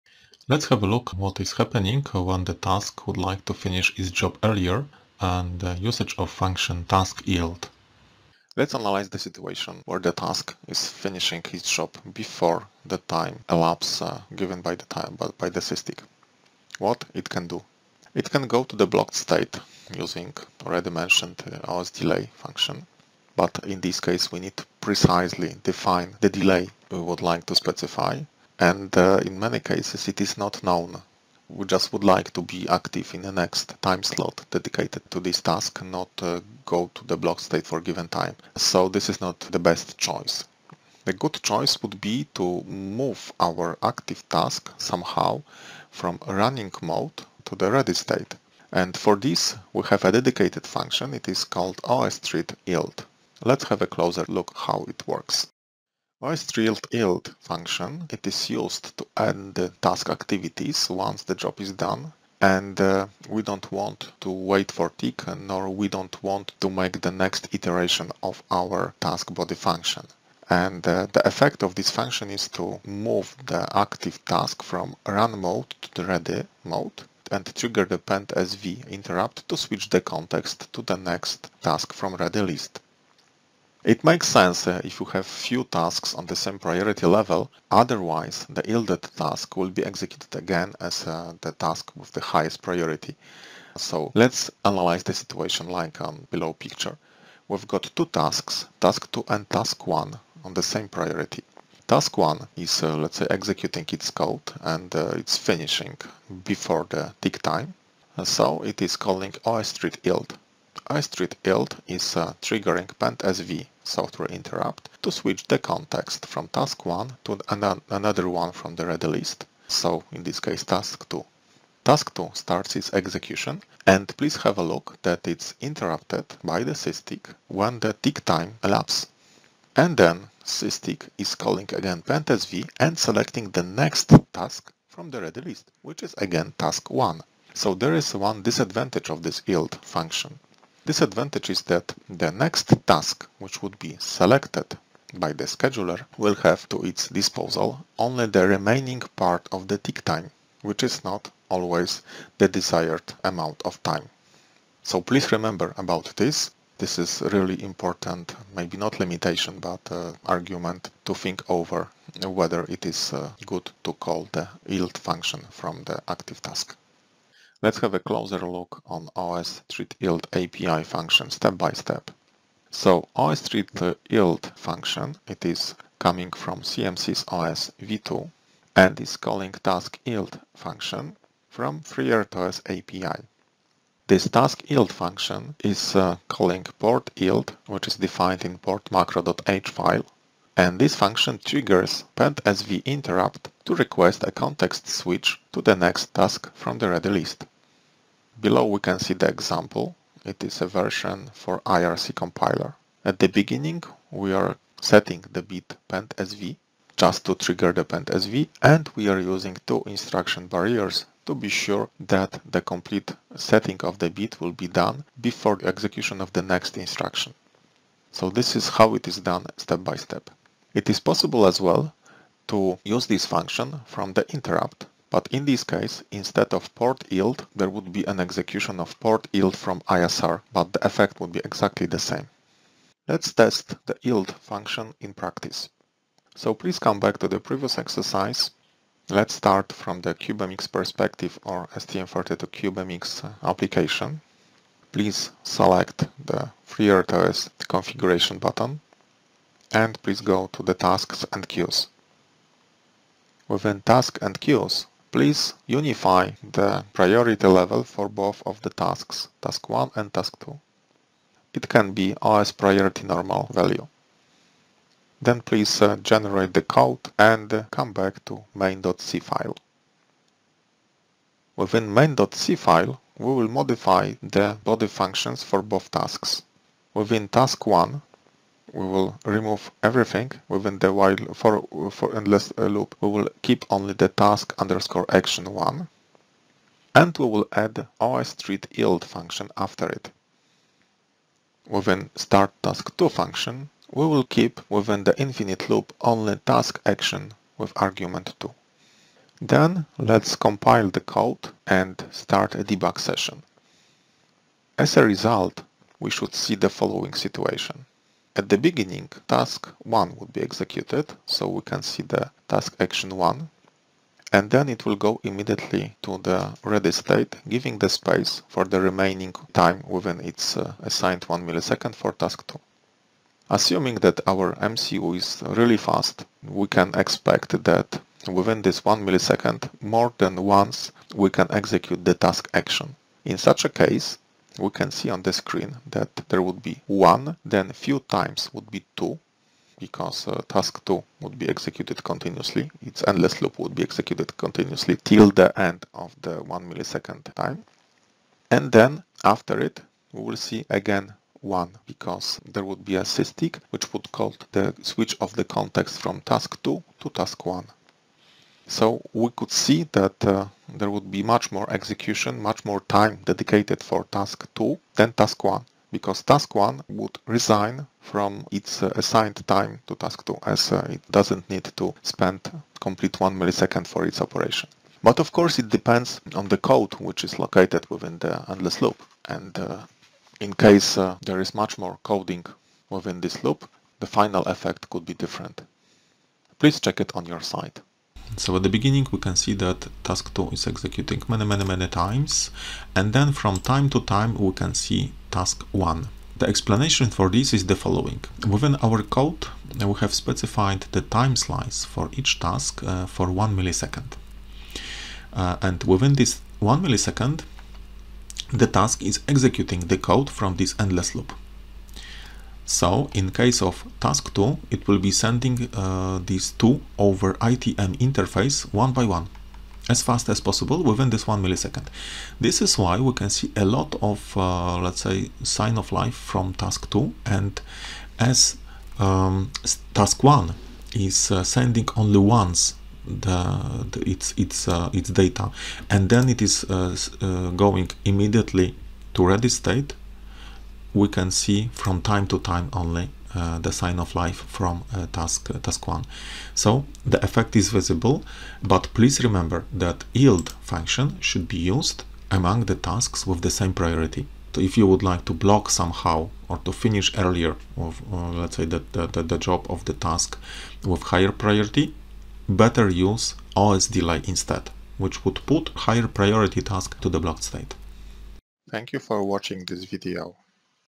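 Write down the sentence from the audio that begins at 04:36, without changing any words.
Within task 1, we will remove everything within the while for, for endless loop.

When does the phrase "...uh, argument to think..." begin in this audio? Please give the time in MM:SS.
02:39.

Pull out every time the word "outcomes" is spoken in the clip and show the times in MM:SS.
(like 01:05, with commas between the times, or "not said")
not said.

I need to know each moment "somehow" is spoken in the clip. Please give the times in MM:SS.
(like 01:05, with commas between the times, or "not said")
00:44, 07:35.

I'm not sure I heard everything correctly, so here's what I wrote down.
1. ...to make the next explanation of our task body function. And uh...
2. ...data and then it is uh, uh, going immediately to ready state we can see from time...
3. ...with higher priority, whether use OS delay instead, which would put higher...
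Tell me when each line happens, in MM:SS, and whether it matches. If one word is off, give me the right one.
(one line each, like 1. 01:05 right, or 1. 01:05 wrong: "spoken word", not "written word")
1. 01:06 wrong: "iteration", not "explanation"
2. 07:15 right
3. 07:40 wrong: "better", not "whether".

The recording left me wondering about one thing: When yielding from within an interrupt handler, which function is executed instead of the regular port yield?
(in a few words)
port yield from ISR.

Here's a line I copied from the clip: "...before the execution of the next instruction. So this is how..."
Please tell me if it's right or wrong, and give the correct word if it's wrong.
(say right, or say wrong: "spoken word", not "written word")
right.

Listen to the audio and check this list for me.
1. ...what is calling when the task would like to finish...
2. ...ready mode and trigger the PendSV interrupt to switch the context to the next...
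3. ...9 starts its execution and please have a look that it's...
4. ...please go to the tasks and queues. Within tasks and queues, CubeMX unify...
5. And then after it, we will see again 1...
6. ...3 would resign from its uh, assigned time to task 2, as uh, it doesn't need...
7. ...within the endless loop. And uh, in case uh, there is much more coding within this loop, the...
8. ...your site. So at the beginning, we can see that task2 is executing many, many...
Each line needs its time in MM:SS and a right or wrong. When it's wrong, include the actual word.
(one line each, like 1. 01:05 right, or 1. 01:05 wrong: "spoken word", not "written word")
1. 00:01 wrong: "happening", not "calling"
2. 01:16 right
3. 02:02 wrong: "2", not "9"
4. 04:10 wrong: "Please", not "CubeMX"
5. 05:48 right
6. 06:06 wrong: "1", not "3"
7. 06:17 right
8. 06:27 right.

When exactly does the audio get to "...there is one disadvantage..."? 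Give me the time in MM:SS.
02:17.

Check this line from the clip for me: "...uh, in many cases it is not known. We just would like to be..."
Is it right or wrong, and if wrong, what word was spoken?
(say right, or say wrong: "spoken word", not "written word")
right.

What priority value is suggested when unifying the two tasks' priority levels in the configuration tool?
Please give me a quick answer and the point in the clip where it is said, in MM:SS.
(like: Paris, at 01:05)
OS priority normal, at 04:22.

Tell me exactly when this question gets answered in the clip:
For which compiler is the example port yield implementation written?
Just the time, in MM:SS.
03:21.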